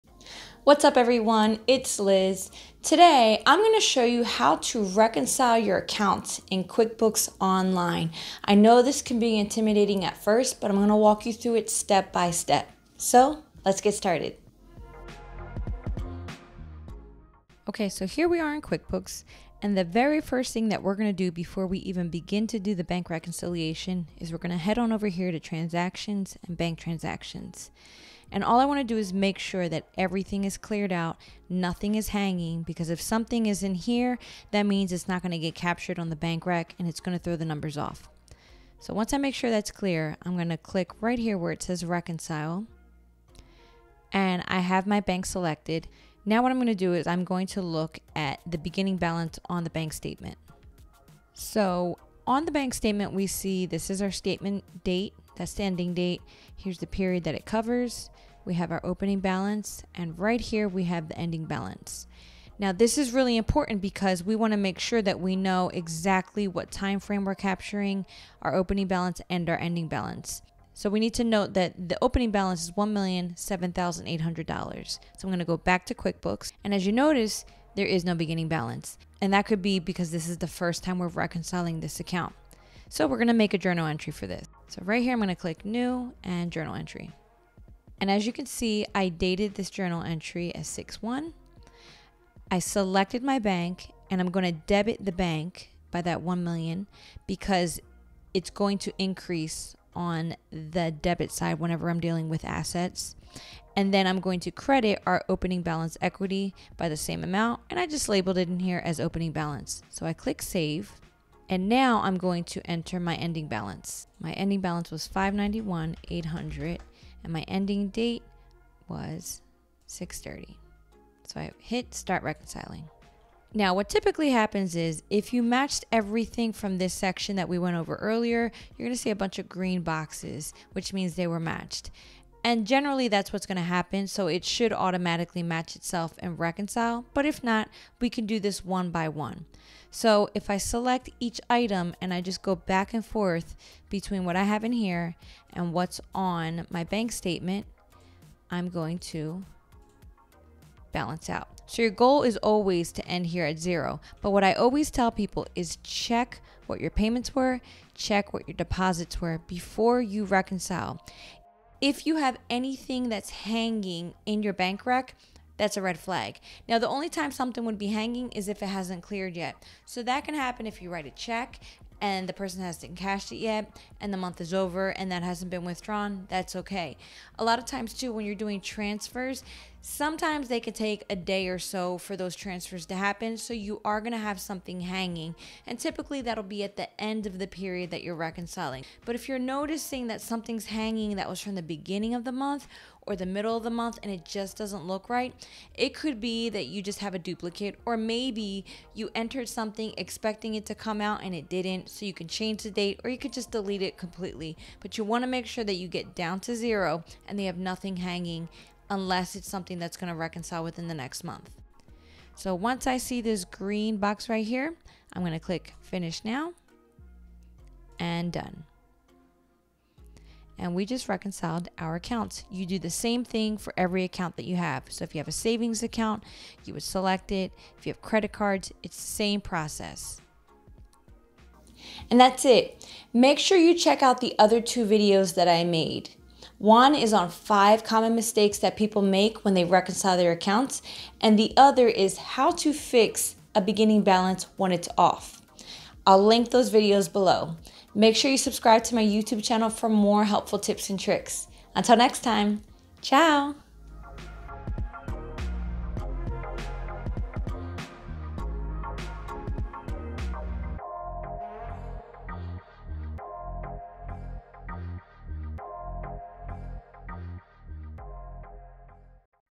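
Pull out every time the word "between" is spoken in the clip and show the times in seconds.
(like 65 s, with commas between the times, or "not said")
143 s.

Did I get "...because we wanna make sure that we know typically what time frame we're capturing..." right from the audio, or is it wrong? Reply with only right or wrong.
wrong.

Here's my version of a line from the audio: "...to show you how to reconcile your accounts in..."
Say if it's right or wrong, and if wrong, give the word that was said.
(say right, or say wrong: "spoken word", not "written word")
right.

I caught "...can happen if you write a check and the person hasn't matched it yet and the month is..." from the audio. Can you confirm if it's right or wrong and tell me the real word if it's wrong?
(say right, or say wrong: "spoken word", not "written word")
wrong: "cashed", not "matched".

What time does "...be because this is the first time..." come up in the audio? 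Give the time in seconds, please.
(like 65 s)
79 s.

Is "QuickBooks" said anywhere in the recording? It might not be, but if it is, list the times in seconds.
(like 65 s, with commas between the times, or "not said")
6 s, 18 s, 75 s.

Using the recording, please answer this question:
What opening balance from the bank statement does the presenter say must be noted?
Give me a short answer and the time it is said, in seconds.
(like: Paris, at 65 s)
$1,007,800, at 72 s.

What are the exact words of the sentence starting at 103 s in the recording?
And then I'm going to credit our opening balance equity by the same amount.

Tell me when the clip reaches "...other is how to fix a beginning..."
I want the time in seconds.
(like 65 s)
241 s.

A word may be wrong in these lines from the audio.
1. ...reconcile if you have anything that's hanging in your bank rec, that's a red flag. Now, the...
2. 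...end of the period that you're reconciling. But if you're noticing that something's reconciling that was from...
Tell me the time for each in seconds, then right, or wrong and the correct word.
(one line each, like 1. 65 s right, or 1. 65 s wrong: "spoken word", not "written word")
1. 160 s right
2. 187 s wrong: "hanging", not "reconciling".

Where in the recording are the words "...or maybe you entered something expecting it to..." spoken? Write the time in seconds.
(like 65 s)
197 s.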